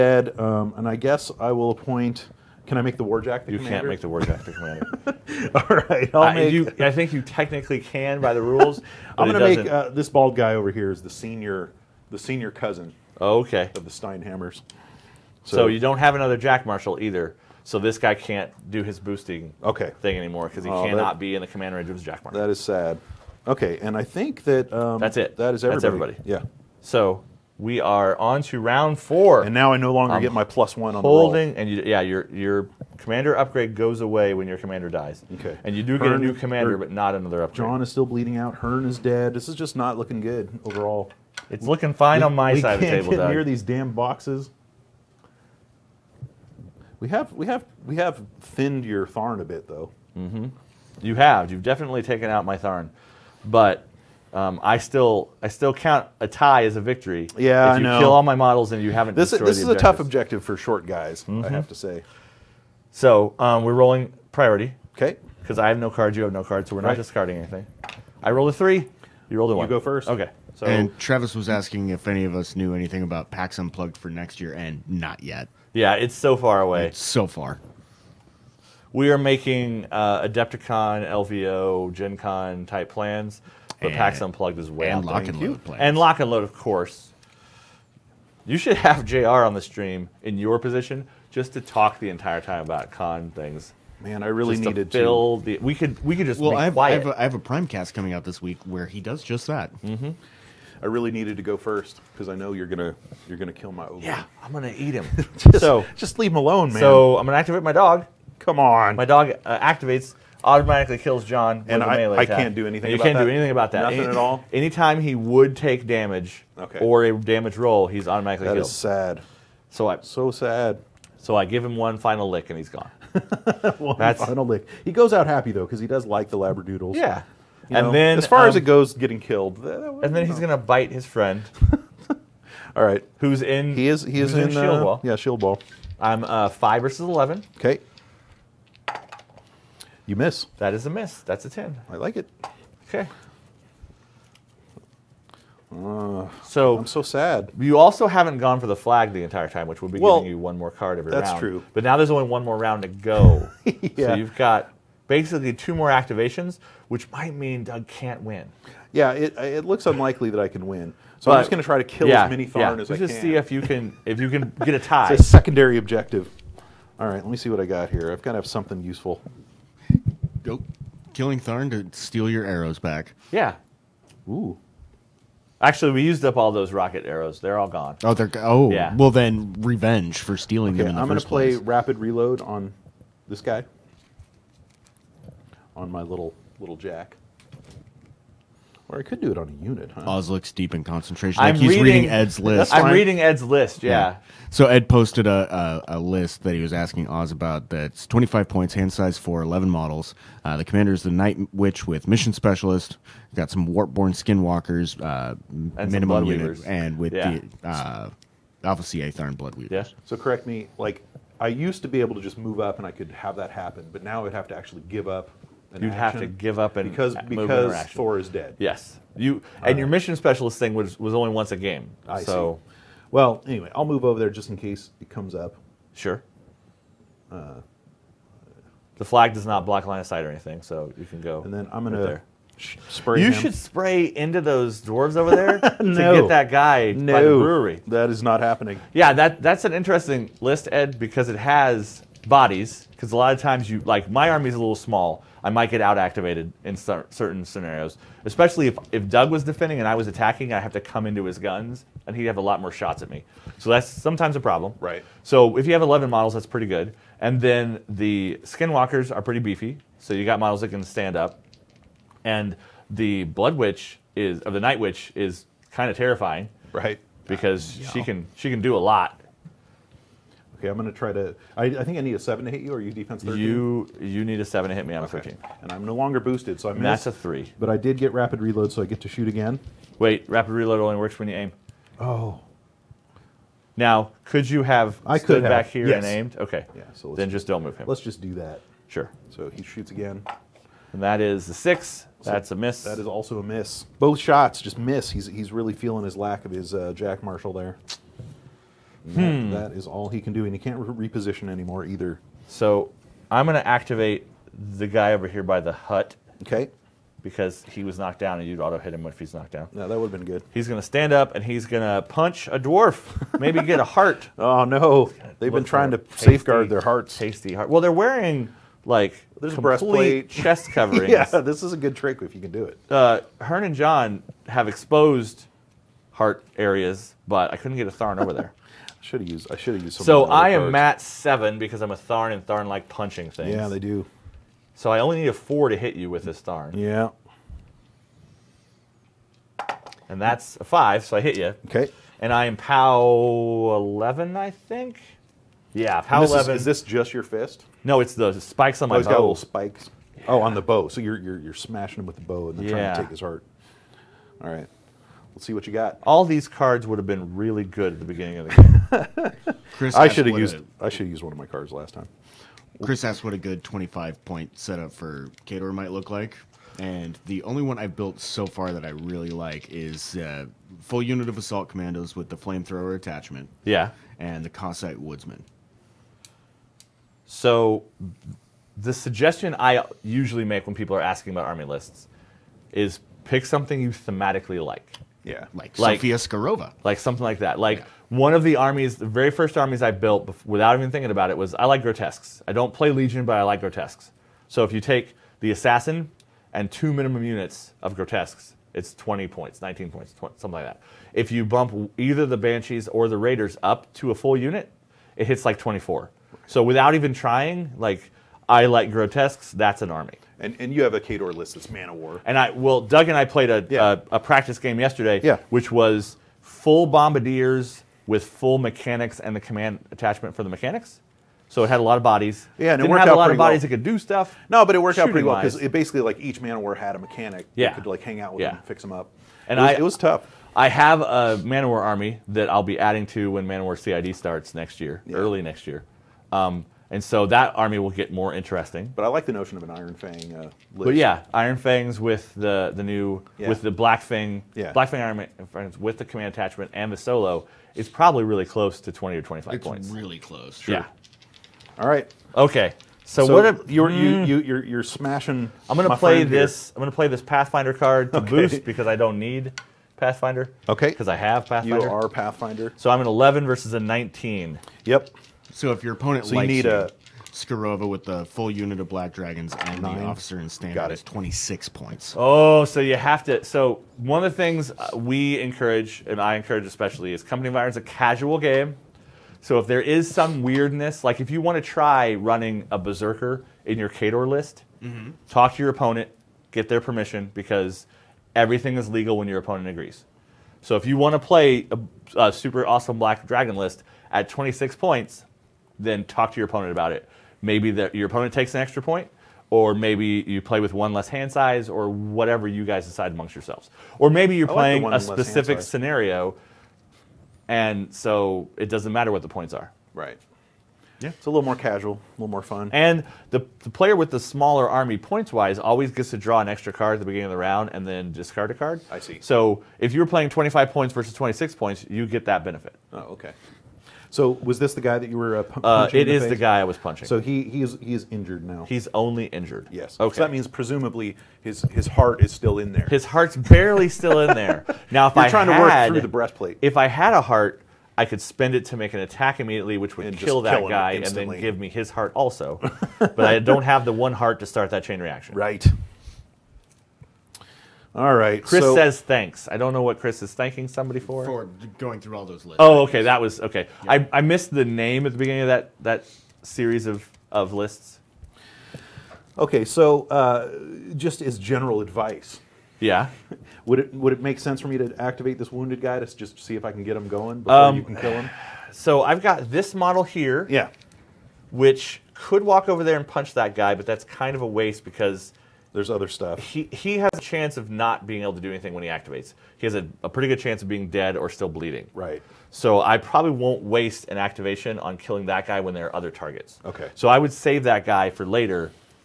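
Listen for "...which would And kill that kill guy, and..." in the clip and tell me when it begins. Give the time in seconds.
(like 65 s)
539 s.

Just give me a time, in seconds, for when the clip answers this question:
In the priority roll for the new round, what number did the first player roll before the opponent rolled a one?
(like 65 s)
68 s.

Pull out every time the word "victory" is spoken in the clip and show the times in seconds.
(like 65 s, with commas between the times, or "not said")
56 s.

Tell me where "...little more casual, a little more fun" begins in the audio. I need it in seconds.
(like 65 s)
511 s.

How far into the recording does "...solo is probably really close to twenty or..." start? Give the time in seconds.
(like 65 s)
446 s.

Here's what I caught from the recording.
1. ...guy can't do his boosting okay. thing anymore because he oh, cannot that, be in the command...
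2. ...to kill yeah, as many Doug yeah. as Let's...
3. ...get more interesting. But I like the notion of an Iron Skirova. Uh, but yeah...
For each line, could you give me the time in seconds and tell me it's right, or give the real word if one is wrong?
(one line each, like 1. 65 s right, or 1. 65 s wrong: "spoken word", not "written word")
1. 17 s right
2. 161 s wrong: "Tharn", not "Doug"
3. 437 s wrong: "Fang", not "Skirova".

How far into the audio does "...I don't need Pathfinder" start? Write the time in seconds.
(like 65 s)
458 s.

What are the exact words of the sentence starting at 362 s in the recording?
Chris asked what a good 25 point setup for Khador might look like.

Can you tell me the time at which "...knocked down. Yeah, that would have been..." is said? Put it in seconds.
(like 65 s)
309 s.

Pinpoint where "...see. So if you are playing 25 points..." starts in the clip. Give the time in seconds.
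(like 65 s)
518 s.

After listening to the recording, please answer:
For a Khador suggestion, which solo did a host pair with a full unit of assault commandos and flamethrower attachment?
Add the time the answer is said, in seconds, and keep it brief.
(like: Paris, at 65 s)
Kossite Woodsman, at 374 s.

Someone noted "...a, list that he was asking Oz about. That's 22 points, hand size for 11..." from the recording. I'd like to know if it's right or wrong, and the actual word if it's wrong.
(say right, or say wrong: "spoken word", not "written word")
wrong: "25", not "22".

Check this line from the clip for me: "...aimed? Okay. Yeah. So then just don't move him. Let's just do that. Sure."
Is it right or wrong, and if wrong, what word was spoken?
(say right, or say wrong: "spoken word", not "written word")
right.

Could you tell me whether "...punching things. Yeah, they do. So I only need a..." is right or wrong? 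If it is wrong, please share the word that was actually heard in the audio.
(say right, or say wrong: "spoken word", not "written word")
right.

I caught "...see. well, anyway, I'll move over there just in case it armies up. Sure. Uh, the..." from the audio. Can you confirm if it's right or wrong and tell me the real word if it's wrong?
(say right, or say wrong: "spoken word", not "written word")
wrong: "comes", not "armies".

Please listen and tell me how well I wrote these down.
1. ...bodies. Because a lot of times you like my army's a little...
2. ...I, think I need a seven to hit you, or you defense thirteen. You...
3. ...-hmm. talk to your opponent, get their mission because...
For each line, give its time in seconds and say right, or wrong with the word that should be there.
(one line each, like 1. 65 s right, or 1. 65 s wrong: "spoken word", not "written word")
1. 242 s right
2. 271 s right
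3. 484 s wrong: "permission", not "mission".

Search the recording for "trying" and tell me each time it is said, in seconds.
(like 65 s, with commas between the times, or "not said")
315 s, 352 s, 407 s, 535 s.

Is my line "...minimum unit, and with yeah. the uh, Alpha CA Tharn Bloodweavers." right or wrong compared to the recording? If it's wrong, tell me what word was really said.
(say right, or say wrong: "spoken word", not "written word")
right.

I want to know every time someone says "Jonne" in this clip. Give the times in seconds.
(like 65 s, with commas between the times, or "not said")
37 s, 111 s, 323 s.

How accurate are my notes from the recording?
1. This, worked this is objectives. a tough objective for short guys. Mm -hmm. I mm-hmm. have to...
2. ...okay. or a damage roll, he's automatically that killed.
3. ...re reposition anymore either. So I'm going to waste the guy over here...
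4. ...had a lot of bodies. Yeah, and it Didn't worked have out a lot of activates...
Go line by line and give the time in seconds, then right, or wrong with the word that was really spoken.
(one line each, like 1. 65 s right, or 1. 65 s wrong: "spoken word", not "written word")
1. 59 s wrong: "destroyed", not "worked"
2. 116 s right
3. 300 s wrong: "activate", not "waste"
4. 421 s wrong: "bodies", not "activates".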